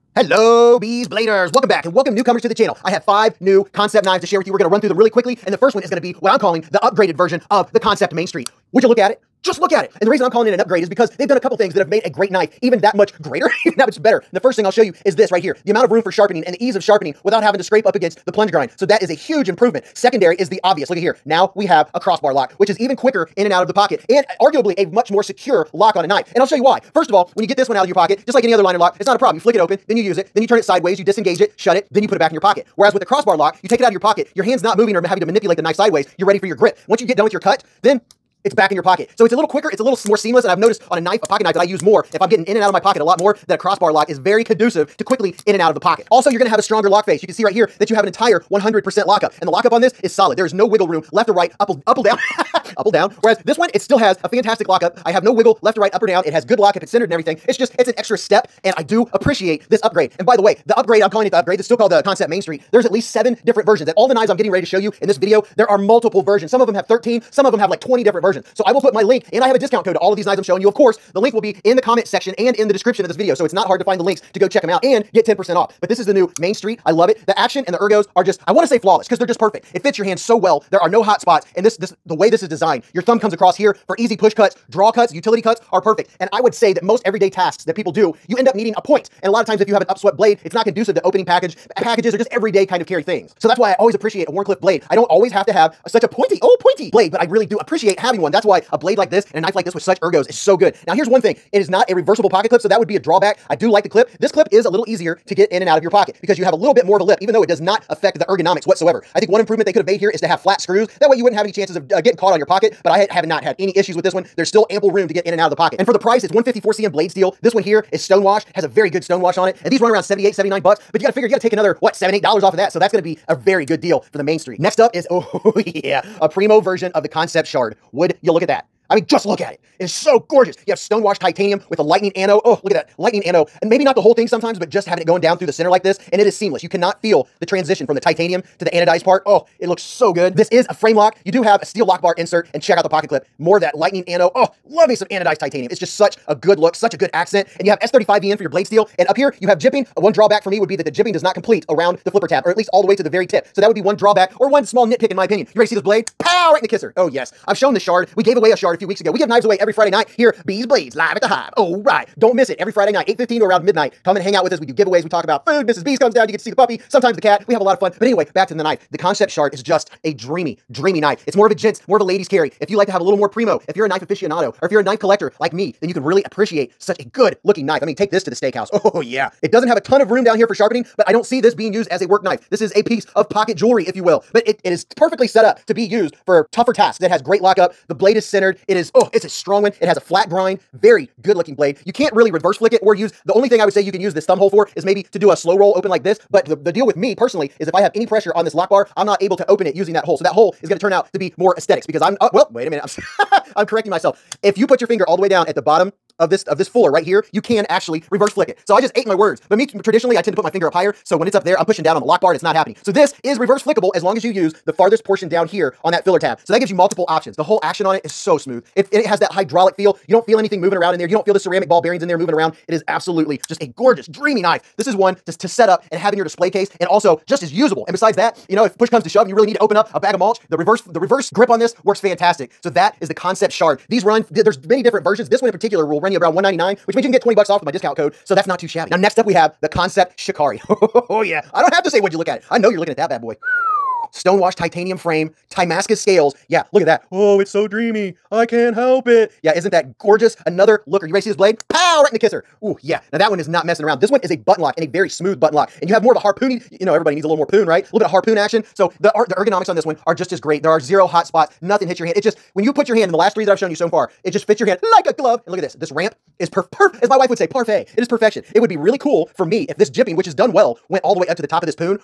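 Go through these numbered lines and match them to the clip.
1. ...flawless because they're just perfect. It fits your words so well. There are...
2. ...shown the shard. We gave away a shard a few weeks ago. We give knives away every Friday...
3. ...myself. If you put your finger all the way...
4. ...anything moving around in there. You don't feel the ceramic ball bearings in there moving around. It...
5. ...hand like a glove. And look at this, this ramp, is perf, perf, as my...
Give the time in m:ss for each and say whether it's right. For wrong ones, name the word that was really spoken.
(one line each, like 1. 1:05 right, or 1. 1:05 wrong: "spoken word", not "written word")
1. 1:18 wrong: "hands", not "words"
2. 2:37 right
3. 3:23 right
4. 3:40 right
5. 4:24 right.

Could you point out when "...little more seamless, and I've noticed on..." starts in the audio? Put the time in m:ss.
0:39.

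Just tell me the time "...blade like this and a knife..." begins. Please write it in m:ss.
1:38.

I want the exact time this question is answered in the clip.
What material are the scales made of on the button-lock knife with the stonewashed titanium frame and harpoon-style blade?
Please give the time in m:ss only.
4:05.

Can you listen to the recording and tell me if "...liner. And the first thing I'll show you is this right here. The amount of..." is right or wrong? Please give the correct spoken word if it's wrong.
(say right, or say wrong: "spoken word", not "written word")
wrong: "better", not "liner".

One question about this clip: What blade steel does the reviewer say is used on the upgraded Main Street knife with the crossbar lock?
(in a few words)
154 cm.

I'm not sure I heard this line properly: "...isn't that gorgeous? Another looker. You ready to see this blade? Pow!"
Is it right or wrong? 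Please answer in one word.
right.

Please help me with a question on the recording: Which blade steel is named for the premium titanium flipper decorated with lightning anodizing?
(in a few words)
S35VN.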